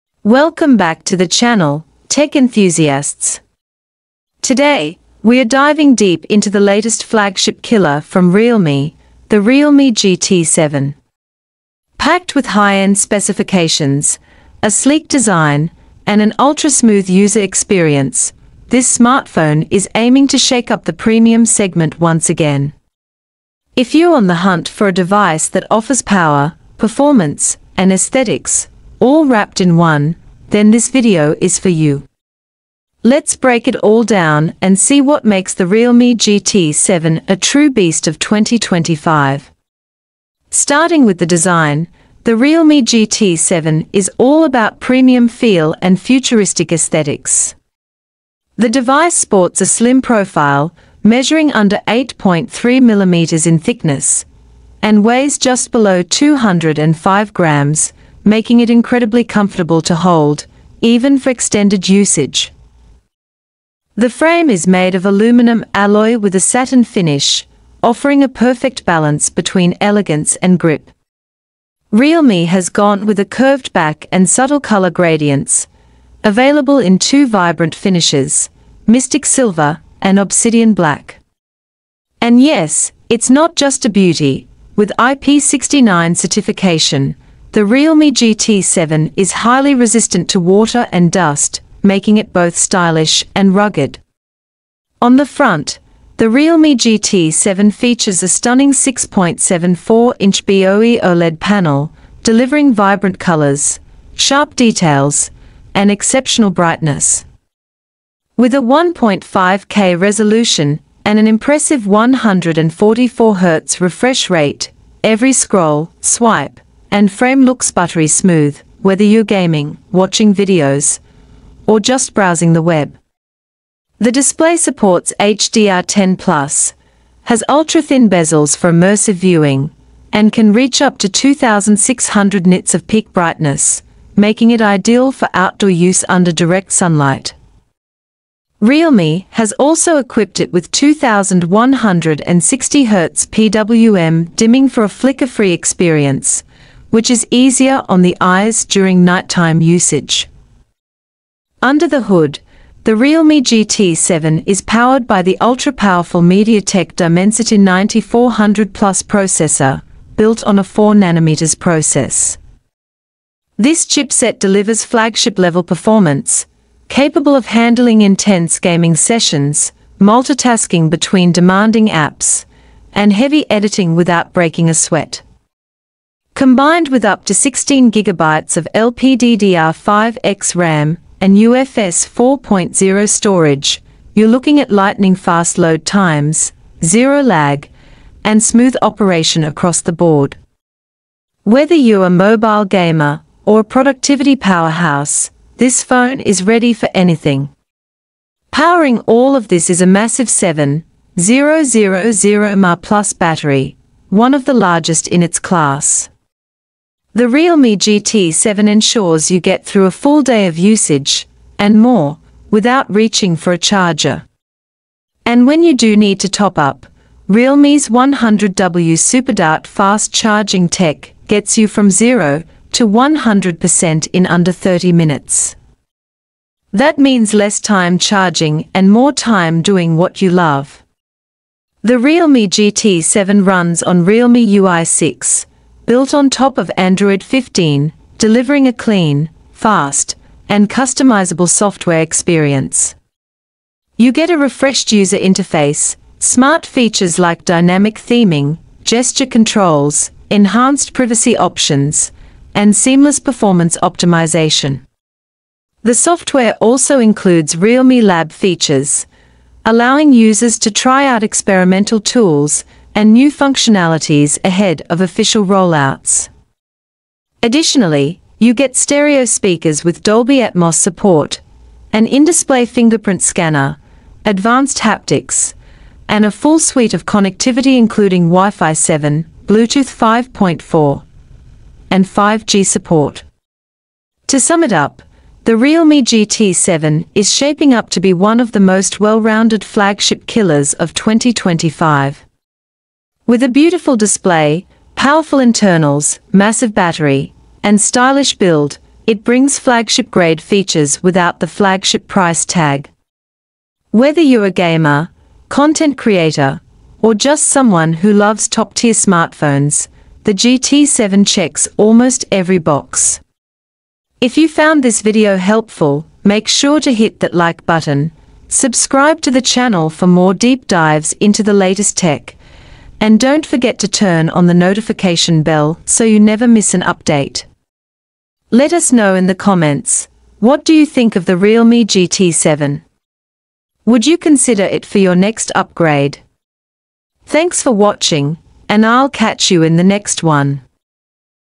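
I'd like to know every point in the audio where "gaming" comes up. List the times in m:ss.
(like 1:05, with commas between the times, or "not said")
1:59, 2:48.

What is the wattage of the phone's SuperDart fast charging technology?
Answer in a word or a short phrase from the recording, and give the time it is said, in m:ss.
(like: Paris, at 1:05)
100W, at 3:37.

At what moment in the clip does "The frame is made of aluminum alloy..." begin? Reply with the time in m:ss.
1:03.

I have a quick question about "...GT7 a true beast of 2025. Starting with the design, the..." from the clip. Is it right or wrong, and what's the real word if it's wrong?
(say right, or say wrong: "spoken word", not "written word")
right.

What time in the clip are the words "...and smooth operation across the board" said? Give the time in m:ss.
3:08.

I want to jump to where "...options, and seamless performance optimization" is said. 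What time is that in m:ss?
4:11.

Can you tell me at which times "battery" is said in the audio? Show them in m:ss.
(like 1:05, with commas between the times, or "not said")
3:23, 4:56.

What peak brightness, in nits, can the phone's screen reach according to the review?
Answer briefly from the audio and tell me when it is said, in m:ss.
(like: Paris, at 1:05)
2600 nits, at 2:11.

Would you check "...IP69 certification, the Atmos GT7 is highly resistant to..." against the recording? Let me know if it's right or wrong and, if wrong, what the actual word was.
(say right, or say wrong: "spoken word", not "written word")
wrong: "Realme", not "Atmos".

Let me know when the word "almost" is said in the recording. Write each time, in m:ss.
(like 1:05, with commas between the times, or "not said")
5:11.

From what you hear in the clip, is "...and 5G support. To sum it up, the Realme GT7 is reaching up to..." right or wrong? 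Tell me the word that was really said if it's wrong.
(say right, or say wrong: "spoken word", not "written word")
wrong: "shaping", not "reaching".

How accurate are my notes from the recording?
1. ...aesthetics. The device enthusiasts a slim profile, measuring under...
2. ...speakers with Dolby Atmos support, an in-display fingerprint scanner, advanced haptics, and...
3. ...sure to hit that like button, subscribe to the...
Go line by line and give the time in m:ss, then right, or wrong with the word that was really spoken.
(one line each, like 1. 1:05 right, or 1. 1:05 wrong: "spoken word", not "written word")
1. 0:46 wrong: "sports", not "enthusiasts"
2. 4:29 right
3. 5:16 right.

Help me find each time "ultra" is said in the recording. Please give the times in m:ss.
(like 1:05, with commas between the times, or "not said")
0:16, 2:07, 2:35.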